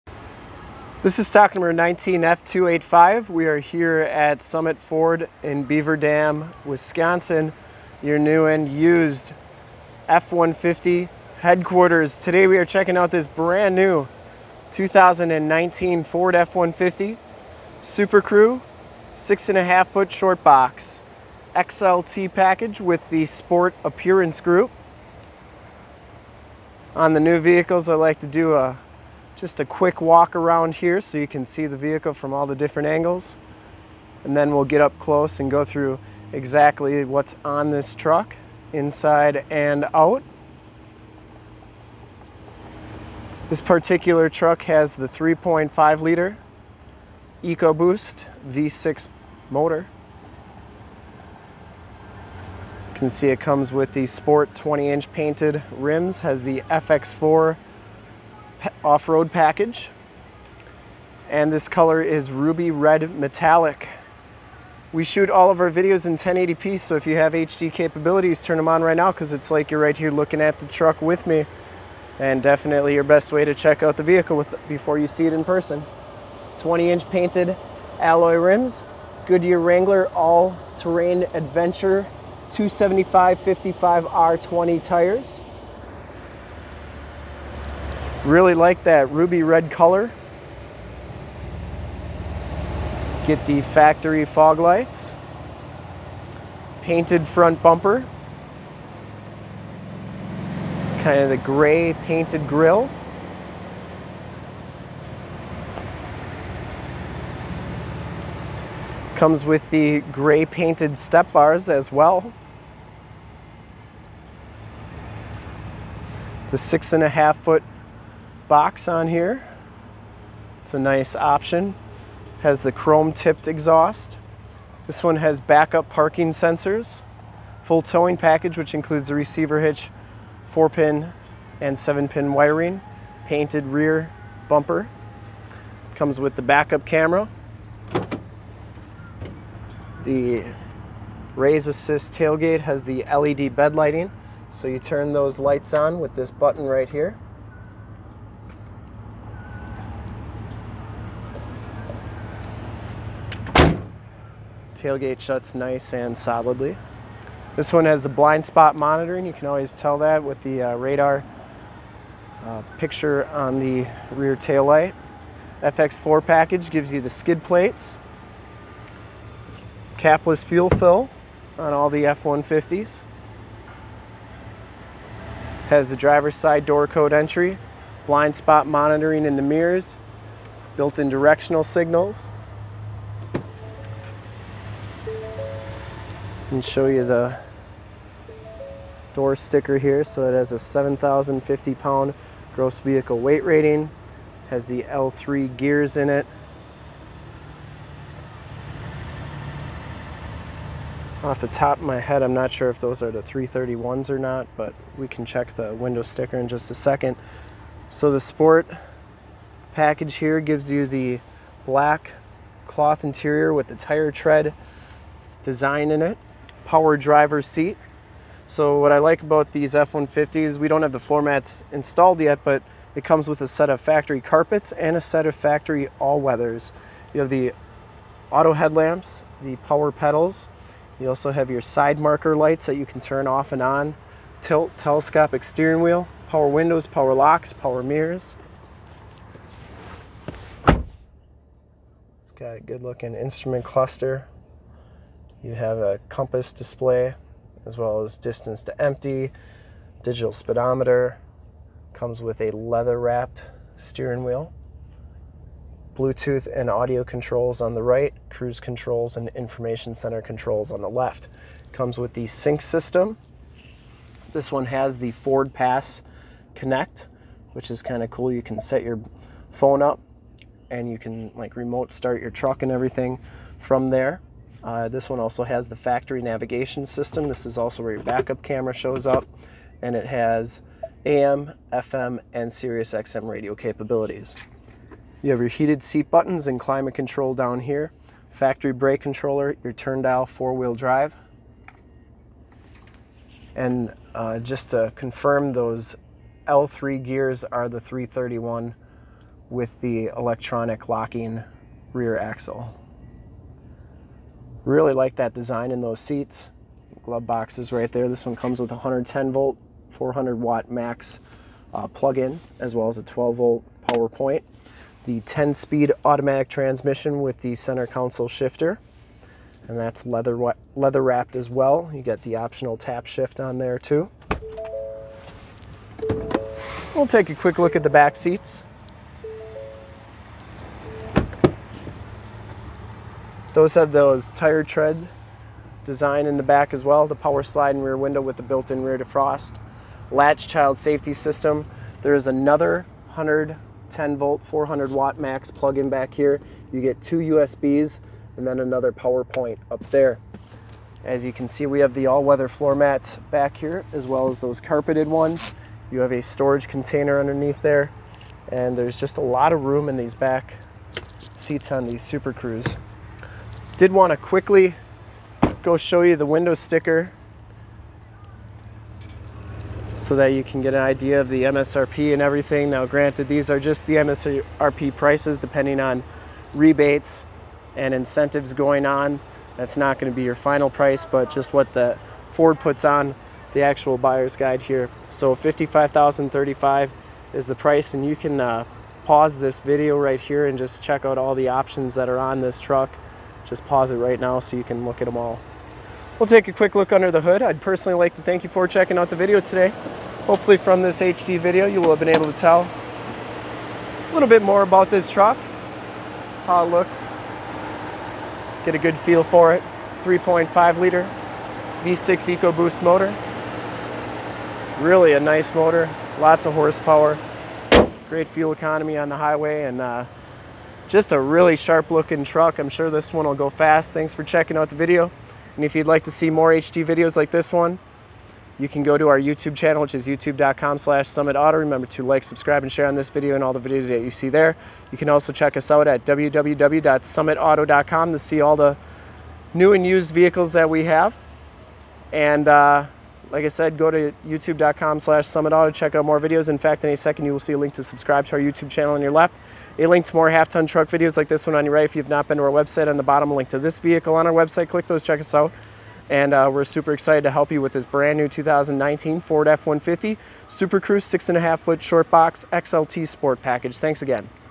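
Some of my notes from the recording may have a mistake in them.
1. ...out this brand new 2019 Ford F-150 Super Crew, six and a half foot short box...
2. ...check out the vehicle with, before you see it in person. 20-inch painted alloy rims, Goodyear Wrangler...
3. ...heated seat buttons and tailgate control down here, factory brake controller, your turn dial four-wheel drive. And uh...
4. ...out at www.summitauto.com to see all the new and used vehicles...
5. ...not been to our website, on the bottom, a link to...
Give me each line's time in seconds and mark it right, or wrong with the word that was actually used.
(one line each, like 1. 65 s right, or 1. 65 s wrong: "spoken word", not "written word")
1. 12 s right
2. 73 s right
3. 285 s wrong: "climate", not "tailgate"
4. 435 s right
5. 452 s right.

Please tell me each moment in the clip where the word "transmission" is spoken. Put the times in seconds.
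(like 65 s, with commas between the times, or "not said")
316 s.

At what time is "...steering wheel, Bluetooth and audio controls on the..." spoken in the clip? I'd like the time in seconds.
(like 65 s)
253 s.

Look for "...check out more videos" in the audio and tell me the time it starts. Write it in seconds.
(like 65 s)
445 s.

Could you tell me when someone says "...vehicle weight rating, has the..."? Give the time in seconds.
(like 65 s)
192 s.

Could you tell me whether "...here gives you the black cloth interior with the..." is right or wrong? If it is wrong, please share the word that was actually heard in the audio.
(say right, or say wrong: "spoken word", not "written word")
right.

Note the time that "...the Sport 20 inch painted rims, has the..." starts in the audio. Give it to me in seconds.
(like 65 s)
53 s.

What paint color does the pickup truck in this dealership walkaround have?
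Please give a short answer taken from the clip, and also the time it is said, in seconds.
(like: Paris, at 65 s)
Ruby red metallic, at 62 s.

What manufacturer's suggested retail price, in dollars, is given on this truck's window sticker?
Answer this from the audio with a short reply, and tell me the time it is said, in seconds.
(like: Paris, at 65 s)
$55,035, at 385 s.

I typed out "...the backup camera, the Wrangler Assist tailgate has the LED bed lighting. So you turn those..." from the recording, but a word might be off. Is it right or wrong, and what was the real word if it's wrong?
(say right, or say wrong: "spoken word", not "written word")
wrong: "Raise", not "Wrangler".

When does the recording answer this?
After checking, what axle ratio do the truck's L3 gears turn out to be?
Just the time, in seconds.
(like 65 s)
297 s.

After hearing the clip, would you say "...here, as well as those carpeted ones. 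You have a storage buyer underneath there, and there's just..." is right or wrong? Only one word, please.
wrong.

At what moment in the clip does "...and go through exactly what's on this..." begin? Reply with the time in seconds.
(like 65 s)
35 s.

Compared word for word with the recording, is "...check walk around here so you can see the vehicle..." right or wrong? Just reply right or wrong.
wrong.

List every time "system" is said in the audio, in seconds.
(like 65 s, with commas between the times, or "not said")
262 s, 276 s, 341 s.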